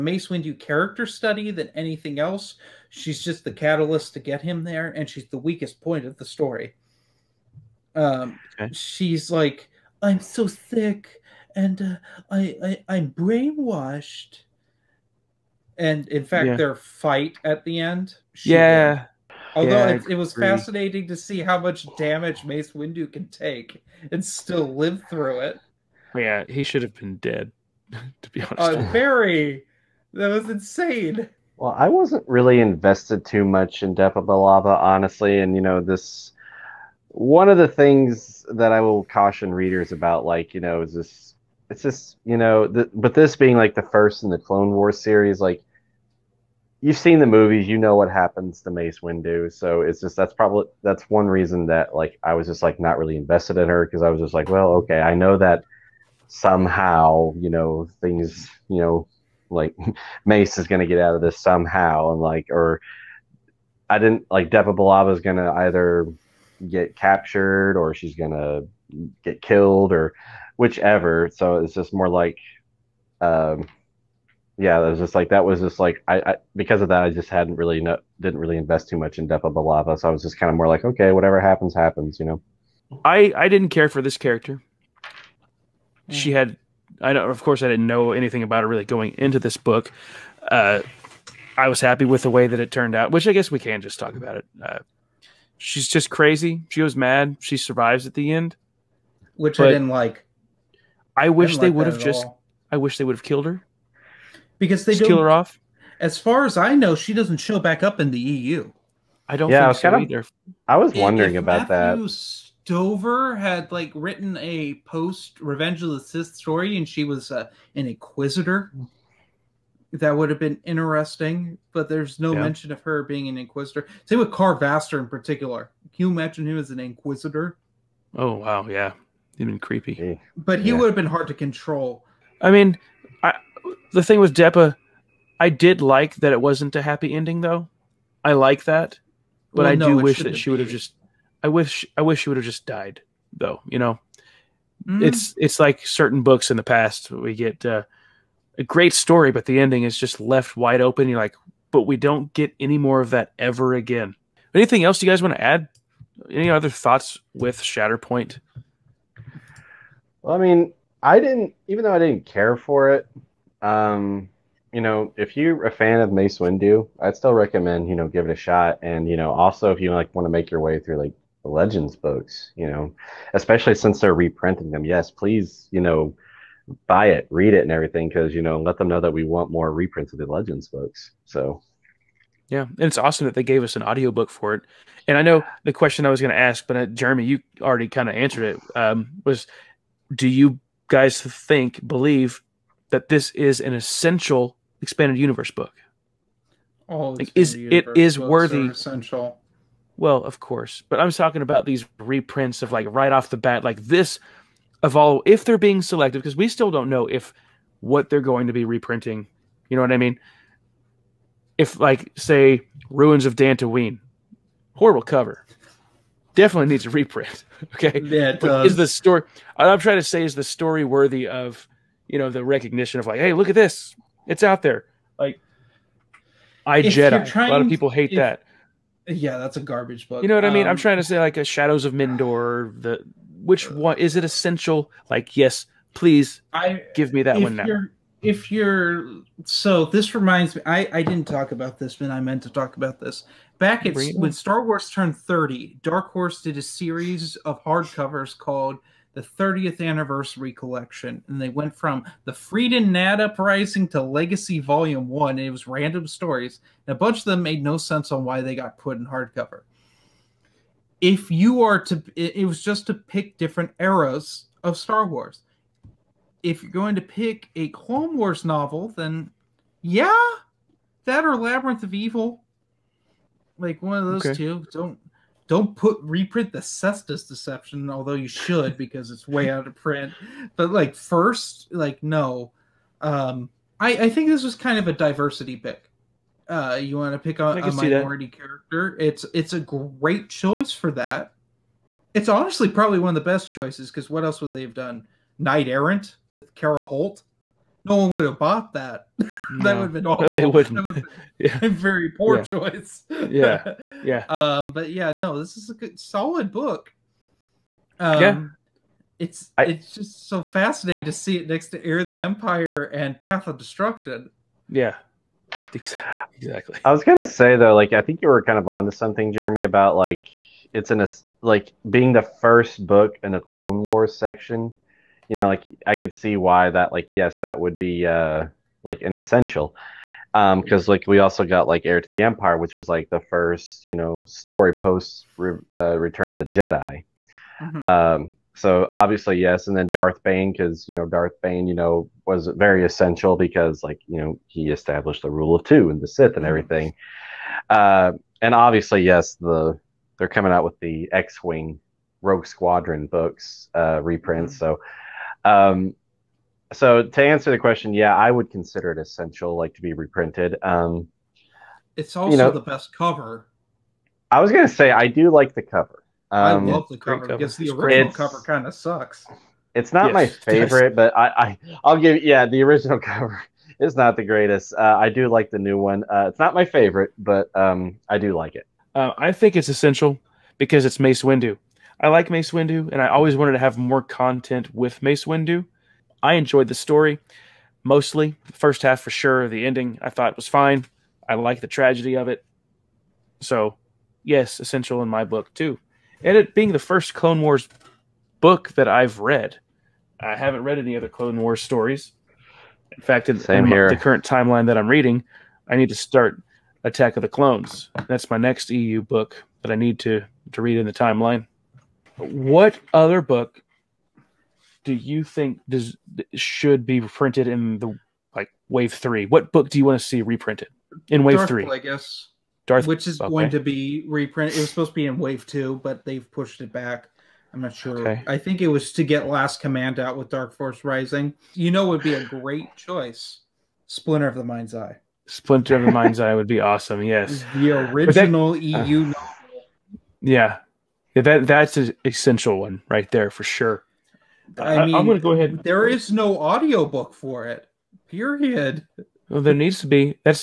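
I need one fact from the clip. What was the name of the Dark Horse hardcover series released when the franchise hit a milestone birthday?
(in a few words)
30th anniversary collection.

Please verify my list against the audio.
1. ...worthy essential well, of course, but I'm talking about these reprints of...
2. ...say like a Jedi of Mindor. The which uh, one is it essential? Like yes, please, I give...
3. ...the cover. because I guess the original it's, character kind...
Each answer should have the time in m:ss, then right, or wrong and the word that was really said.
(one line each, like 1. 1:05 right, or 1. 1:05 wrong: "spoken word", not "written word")
1. 3:18 right
2. 3:51 wrong: "Shadows", not "Jedi"
3. 6:06 wrong: "cover", not "character".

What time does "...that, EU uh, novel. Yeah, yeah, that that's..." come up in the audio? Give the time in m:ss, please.
7:18.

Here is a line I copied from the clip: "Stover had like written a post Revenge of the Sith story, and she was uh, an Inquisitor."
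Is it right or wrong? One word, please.
right.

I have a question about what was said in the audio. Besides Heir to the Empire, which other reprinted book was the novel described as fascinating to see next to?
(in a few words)
Path of Destruction.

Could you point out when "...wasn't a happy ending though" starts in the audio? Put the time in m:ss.
2:16.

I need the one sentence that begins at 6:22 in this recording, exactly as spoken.
I like Mace Windu, and I always wanted to have more content with Mace Windu.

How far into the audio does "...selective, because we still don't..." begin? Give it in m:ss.
3:25.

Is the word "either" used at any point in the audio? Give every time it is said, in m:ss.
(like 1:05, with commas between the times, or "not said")
1:05, 1:50.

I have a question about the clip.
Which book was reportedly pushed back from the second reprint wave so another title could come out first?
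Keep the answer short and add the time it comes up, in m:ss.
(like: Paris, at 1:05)
Last Command, at 7:09.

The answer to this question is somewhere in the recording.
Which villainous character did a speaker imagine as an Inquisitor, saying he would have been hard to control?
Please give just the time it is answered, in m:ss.
2:04.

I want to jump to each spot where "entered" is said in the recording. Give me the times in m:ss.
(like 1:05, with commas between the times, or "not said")
not said.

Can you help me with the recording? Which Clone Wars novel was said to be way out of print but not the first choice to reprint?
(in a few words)
The Cestus Deception.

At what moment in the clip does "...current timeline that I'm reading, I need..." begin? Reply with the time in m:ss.
6:43.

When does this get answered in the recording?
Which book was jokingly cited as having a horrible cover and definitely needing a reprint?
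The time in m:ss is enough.
3:32.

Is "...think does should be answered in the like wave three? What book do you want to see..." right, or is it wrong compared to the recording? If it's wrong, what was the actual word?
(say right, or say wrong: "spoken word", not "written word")
wrong: "printed", not "answered".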